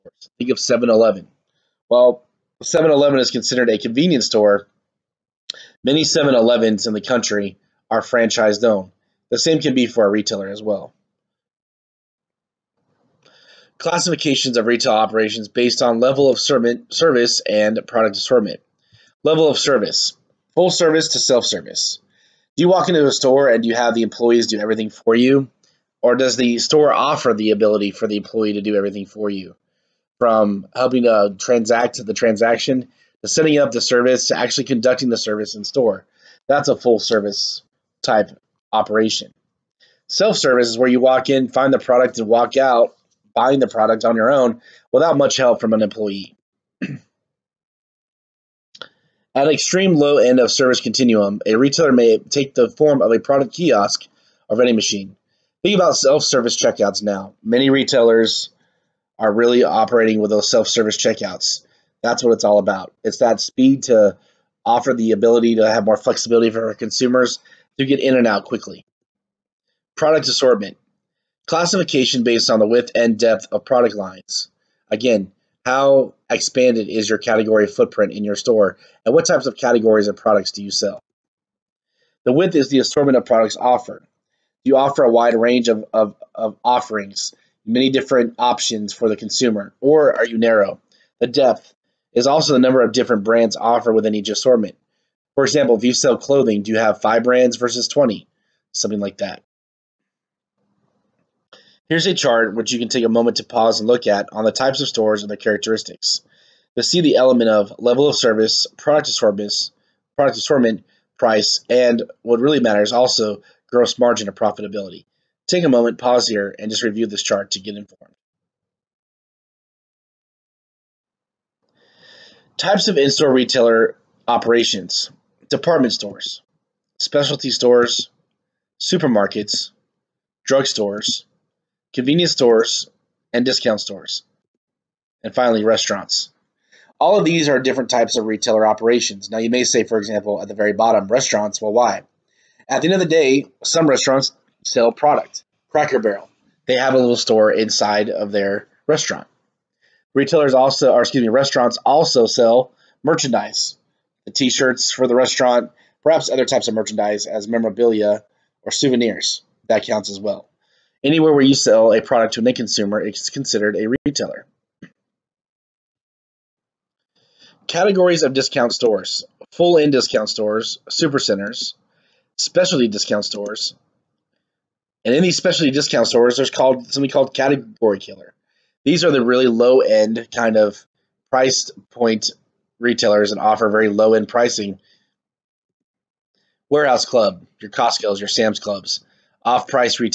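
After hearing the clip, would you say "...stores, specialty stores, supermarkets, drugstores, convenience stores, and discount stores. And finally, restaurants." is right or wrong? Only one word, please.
right.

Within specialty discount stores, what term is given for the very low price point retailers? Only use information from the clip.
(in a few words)
Category killer.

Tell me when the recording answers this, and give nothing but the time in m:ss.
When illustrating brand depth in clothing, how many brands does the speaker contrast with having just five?
1:37.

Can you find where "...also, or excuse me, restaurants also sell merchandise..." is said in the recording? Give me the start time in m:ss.
2:30.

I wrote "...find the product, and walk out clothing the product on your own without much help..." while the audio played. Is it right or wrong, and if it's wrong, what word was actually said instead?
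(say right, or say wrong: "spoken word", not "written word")
wrong: "buying", not "clothing".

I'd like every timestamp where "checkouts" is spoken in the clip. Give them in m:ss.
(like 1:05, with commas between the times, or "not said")
0:56, 1:00.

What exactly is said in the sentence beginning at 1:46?
You'll see the element of level of service, product assortment, product assortment, price, and what really matters also gross margin or profitability.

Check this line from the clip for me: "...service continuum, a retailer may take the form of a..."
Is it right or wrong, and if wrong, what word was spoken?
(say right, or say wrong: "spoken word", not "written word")
right.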